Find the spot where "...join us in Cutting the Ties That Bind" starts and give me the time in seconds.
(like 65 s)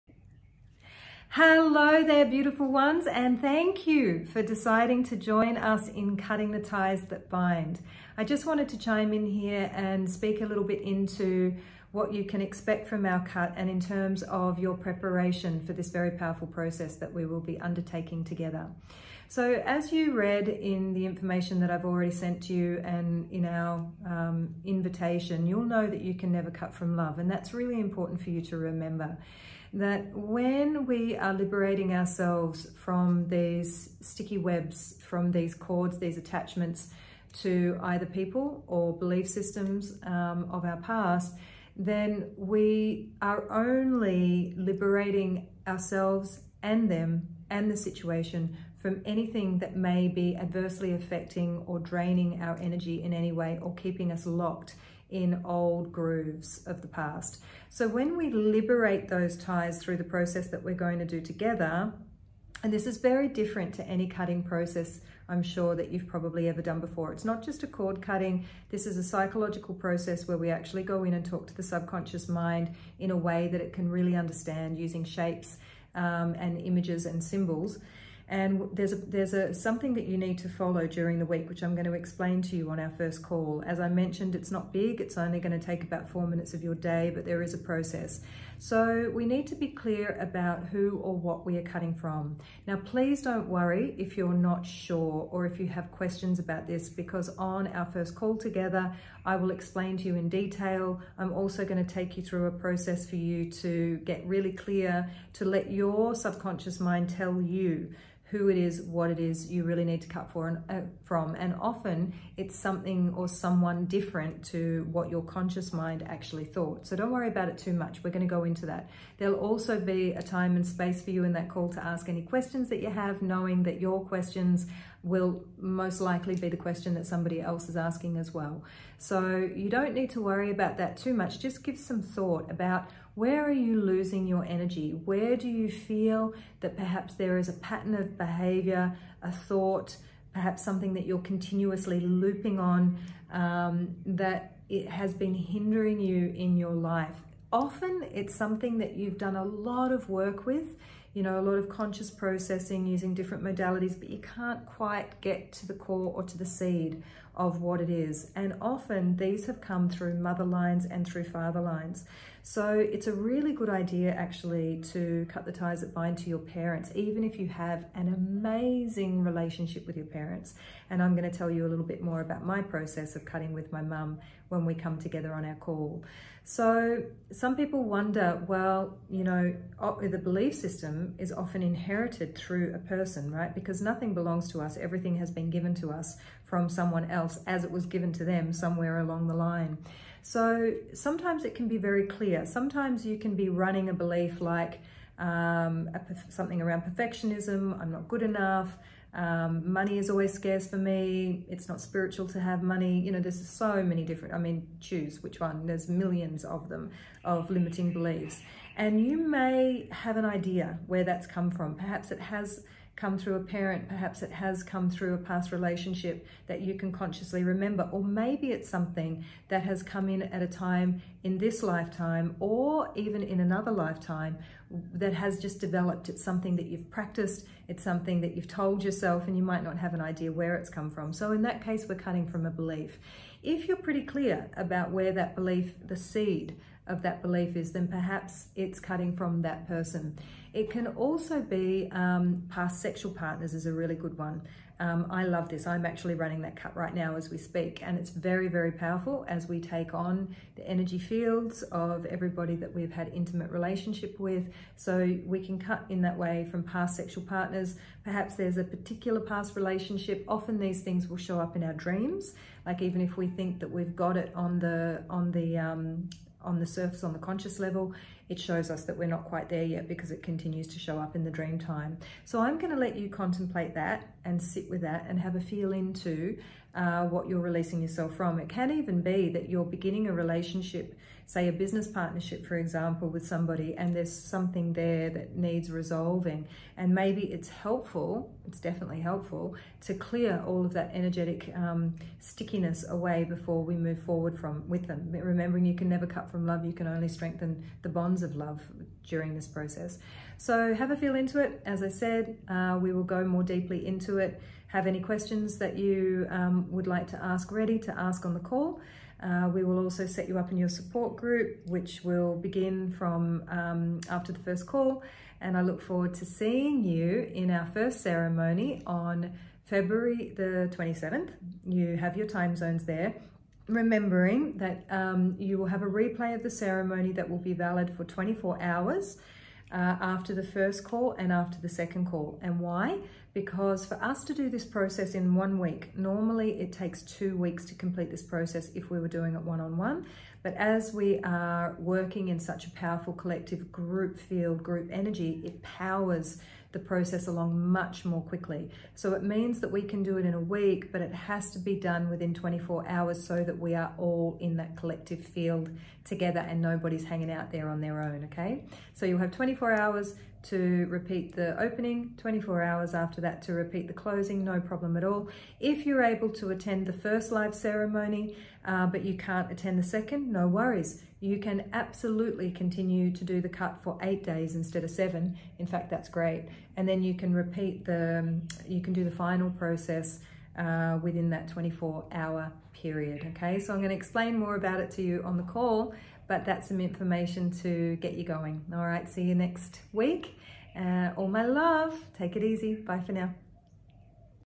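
5 s.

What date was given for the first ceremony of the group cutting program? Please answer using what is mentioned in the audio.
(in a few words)
February 27.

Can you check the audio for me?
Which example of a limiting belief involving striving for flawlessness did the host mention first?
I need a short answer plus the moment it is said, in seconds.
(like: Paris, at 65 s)
perfectionism, at 196 s.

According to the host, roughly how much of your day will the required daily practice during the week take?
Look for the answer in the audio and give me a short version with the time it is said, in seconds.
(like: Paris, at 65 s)
4 minutes, at 86 s.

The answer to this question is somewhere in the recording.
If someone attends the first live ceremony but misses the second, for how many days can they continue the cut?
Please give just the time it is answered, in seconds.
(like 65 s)
374 s.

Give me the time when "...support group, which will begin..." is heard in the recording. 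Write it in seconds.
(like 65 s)
310 s.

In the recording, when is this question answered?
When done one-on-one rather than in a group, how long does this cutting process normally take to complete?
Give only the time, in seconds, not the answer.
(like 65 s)
337 s.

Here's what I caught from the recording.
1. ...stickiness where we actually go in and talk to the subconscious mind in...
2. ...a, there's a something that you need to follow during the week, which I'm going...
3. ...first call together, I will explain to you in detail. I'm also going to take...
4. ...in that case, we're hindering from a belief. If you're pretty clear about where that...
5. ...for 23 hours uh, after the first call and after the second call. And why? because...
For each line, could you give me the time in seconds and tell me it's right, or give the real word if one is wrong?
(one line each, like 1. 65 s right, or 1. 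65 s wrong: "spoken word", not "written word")
1. 69 s wrong: "process", not "stickiness"
2. 78 s right
3. 97 s right
4. 231 s wrong: "cutting", not "hindering"
5. 327 s wrong: "24", not "23".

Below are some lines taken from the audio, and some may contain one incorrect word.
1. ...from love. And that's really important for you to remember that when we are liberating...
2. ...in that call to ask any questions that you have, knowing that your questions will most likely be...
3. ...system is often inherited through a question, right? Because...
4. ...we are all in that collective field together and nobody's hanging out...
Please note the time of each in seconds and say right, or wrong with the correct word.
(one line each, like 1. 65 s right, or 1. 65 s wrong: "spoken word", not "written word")
1. 26 s right
2. 121 s right
3. 180 s wrong: "person", not "question"
4. 353 s right.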